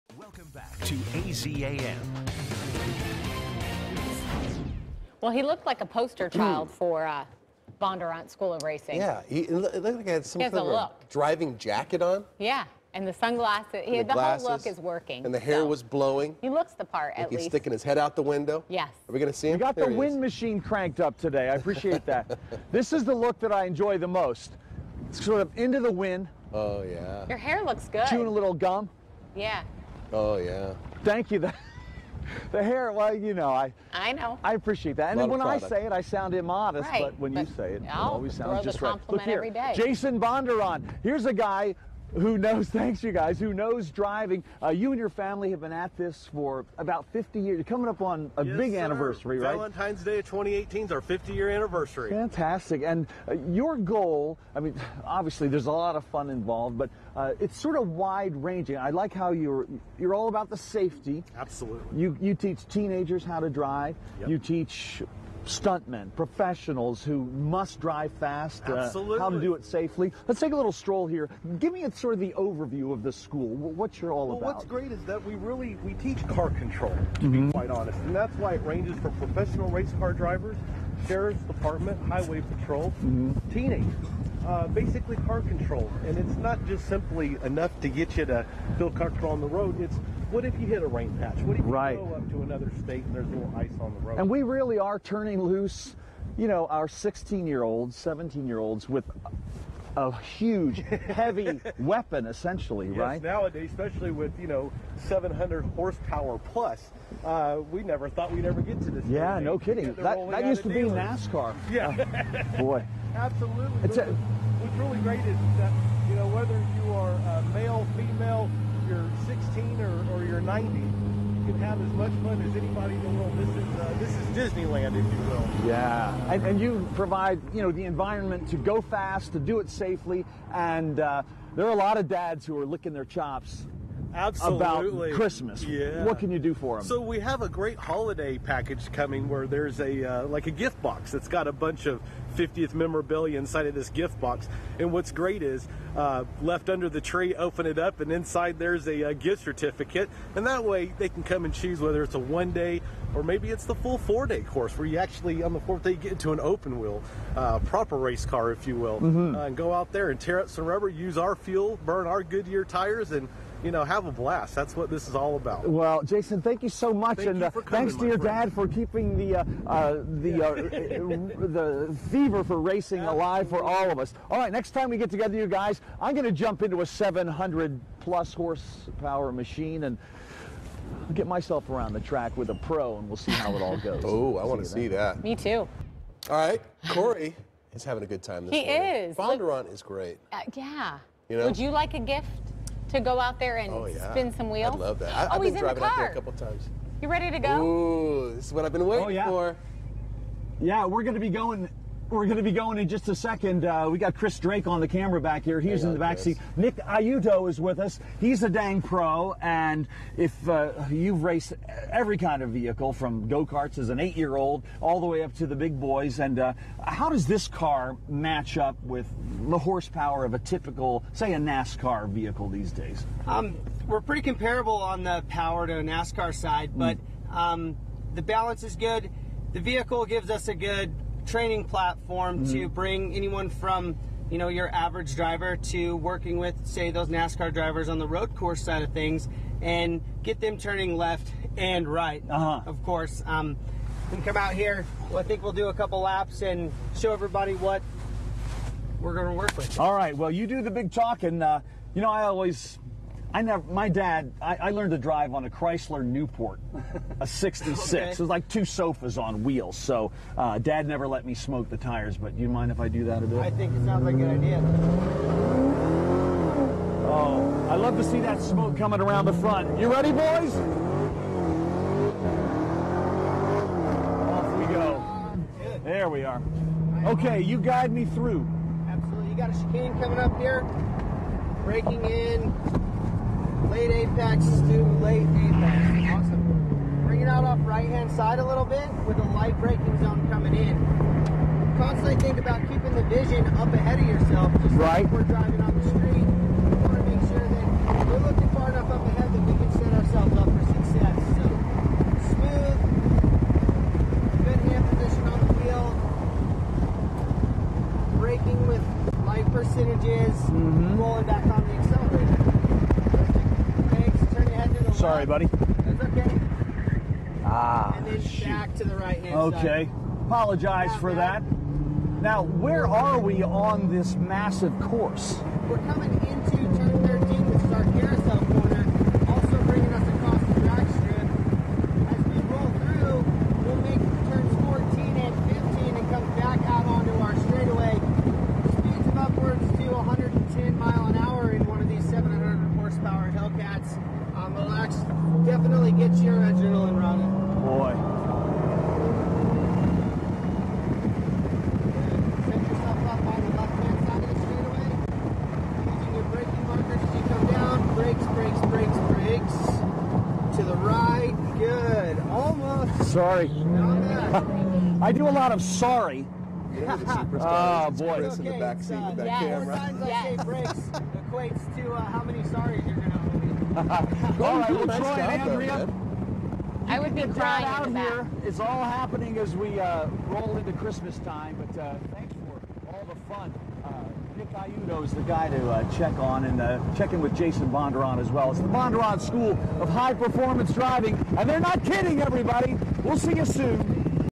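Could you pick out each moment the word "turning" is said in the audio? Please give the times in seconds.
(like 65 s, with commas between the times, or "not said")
94 s, 240 s.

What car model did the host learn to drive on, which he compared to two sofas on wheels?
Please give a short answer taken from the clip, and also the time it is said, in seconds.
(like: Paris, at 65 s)
Chrysler Newport, at 255 s.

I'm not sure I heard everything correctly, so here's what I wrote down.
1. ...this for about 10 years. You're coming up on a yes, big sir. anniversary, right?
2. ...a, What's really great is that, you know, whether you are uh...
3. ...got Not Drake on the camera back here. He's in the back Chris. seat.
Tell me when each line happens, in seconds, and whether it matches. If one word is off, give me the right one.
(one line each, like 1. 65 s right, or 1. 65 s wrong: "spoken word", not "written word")
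1. 45 s wrong: "50", not "10"
2. 113 s right
3. 203 s wrong: "Chris", not "Not".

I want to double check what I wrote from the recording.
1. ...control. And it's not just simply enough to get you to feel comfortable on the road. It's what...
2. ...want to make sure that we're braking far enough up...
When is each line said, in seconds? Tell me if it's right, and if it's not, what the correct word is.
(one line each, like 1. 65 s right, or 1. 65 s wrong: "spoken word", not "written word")
1. 85 s right
2. 296 s wrong: "looking", not "braking".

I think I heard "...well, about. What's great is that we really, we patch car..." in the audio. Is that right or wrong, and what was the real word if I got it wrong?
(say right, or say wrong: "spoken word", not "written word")
wrong: "teach", not "patch".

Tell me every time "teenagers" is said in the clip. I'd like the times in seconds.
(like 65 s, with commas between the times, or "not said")
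62 s, 83 s.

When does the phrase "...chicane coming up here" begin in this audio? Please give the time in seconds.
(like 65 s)
279 s.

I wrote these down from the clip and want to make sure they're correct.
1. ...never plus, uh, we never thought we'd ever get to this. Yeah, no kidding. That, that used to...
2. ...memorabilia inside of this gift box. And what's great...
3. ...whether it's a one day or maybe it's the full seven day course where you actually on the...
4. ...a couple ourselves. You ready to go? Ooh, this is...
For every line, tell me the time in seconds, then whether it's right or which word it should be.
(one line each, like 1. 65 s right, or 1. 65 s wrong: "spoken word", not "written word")
1. 105 s wrong: "horsepower", not "never"
2. 142 s right
3. 151 s wrong: "four", not "seven"
4. 196 s wrong: "times", not "ourselves".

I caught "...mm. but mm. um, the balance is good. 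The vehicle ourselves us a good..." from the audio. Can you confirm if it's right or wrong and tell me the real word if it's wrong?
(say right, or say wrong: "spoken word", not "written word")
wrong: "gives", not "ourselves".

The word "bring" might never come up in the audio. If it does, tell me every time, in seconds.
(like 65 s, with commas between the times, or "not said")
232 s, 287 s.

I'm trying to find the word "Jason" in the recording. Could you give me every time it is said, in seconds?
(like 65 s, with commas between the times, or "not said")
39 s, 166 s, 387 s.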